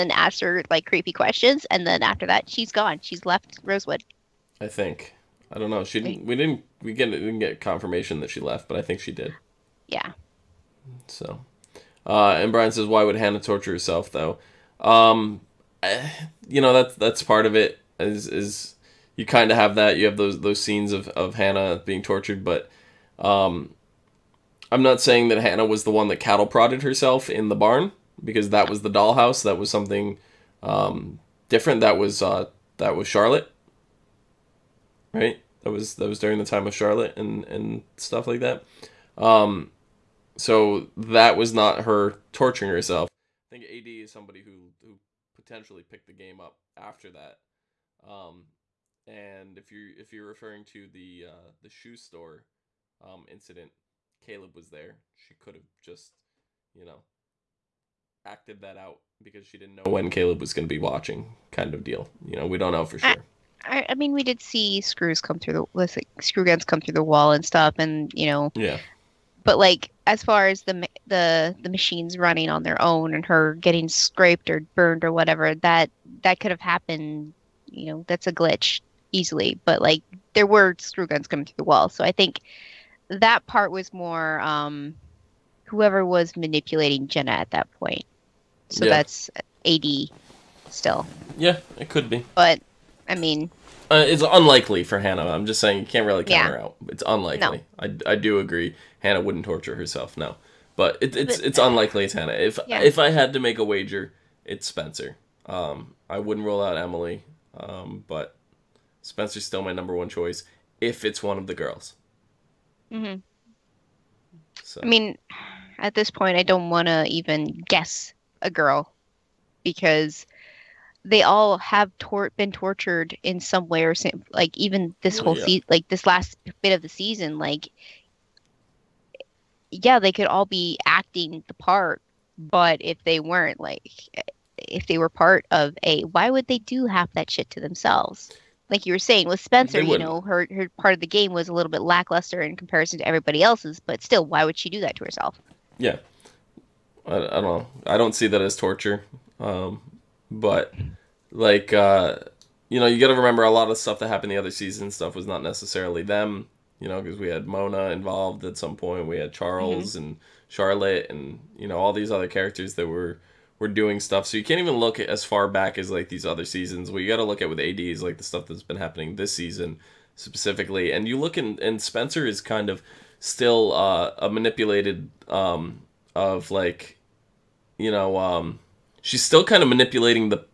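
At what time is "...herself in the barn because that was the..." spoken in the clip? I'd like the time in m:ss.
0:26.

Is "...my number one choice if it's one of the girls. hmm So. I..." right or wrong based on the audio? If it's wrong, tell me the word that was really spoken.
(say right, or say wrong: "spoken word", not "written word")
right.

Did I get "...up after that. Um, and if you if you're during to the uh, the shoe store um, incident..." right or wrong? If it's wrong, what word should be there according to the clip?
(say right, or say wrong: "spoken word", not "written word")
wrong: "referring", not "during".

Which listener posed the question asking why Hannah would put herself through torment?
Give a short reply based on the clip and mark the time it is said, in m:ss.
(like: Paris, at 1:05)
Brian, at 0:12.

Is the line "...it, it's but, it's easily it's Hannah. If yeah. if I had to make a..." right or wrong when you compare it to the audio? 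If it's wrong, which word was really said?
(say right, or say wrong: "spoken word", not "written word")
wrong: "unlikely", not "easily".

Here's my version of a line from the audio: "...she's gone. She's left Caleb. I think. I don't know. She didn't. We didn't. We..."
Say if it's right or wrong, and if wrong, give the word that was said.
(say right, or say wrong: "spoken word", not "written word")
wrong: "Rosewood", not "Caleb".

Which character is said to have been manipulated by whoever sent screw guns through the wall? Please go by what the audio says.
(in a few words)
Jenna.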